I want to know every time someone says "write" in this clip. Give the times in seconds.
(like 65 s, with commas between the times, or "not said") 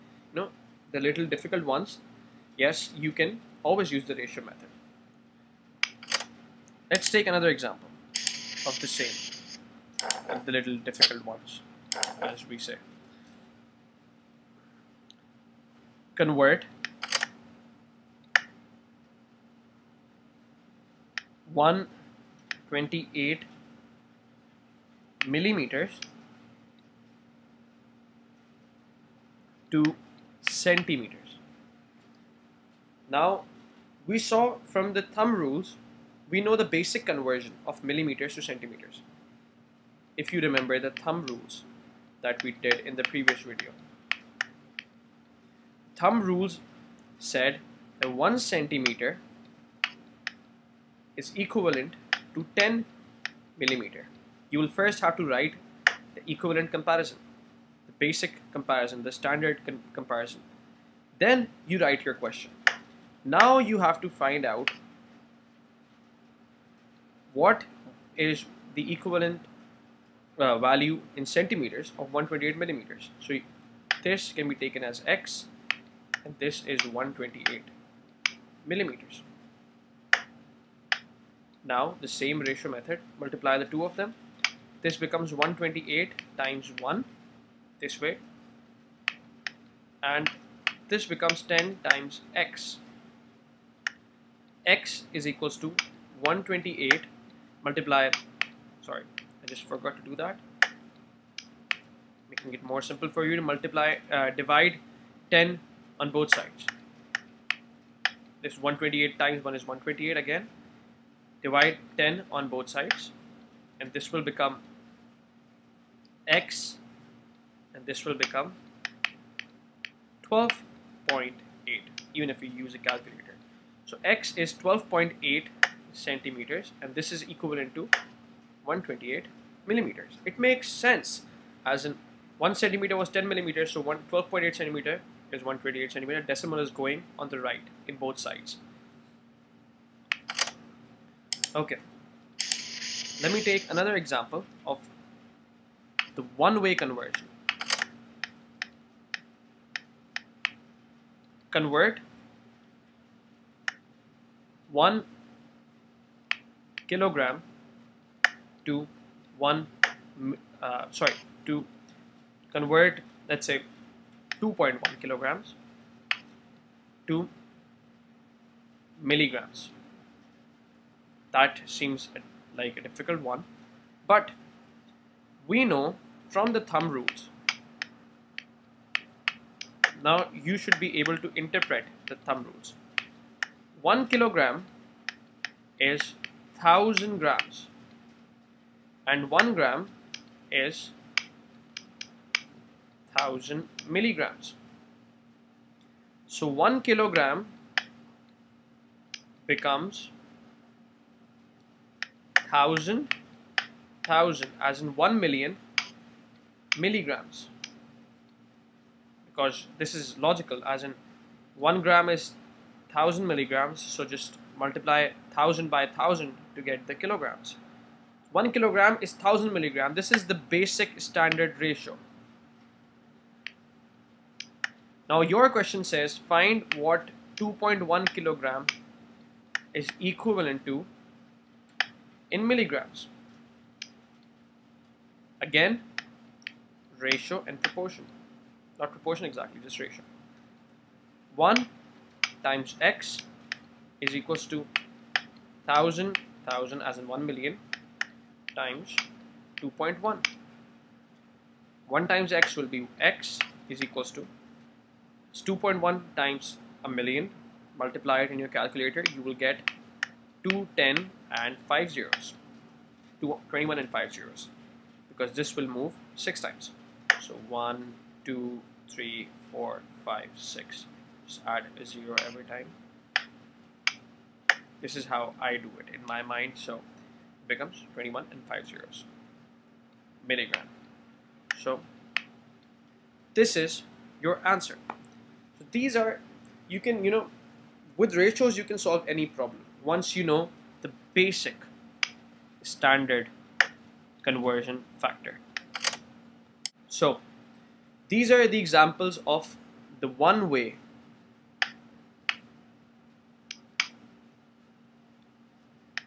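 55 s, 61 s.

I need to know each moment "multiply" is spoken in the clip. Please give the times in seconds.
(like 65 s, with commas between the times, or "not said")
83 s, 97 s, 103 s, 214 s, 257 s.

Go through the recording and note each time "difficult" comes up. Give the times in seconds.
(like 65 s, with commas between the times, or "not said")
1 s, 10 s, 172 s.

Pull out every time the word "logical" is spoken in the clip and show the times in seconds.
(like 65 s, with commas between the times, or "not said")
210 s.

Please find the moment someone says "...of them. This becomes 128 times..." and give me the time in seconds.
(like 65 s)
83 s.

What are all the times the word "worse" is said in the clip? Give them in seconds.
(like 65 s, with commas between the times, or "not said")
not said.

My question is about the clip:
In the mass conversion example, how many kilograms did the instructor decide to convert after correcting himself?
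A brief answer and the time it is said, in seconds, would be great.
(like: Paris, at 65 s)
2.1, at 164 s.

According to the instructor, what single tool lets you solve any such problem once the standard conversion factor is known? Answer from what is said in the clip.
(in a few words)
ratios.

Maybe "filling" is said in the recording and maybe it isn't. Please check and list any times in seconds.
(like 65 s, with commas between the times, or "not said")
not said.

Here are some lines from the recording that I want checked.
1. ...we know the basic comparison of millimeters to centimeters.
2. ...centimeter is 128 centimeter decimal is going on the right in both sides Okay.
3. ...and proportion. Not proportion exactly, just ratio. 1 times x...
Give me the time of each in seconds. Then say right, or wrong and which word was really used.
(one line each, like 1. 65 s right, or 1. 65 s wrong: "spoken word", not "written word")
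1. 36 s wrong: "conversion", not "comparison"
2. 134 s right
3. 237 s right.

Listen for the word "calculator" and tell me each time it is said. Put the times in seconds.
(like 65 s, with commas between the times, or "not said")
122 s, 258 s.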